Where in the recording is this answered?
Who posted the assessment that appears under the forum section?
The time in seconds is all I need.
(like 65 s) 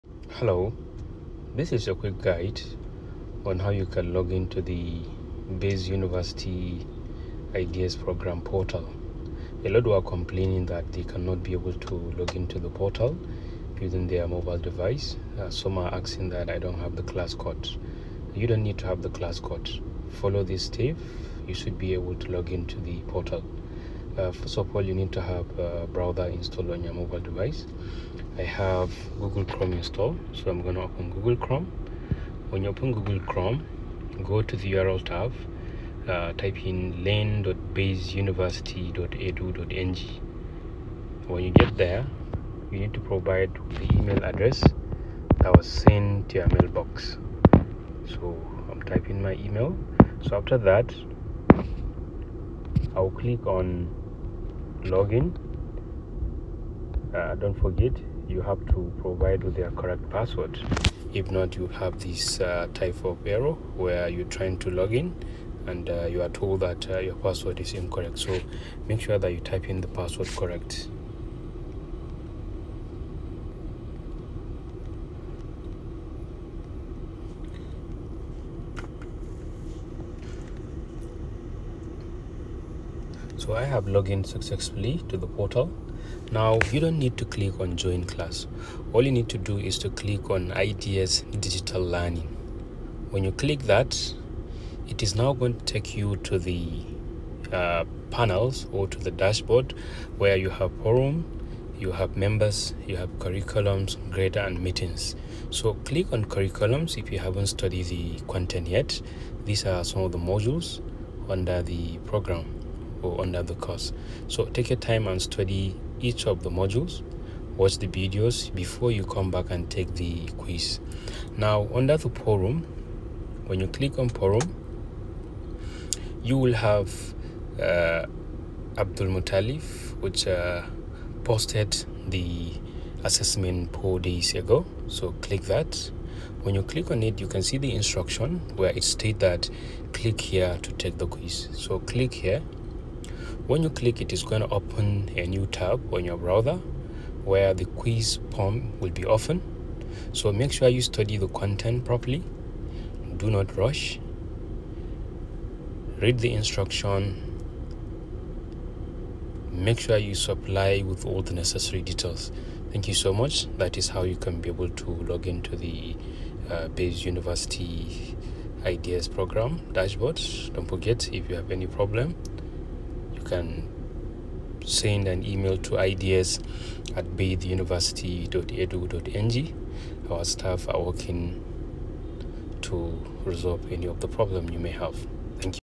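128 s.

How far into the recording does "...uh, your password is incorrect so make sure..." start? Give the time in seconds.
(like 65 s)
66 s.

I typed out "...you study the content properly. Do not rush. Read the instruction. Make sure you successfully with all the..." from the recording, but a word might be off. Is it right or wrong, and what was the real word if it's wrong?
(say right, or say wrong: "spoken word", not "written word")
wrong: "supply", not "successfully".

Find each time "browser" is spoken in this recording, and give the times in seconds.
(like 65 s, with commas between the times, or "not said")
25 s, 146 s.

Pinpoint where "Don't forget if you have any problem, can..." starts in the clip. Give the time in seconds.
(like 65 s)
170 s.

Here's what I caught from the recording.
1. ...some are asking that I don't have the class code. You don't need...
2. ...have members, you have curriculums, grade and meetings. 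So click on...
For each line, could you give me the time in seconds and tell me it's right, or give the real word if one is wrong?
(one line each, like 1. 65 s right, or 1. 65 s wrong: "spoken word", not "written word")
1. 15 s right
2. 101 s right.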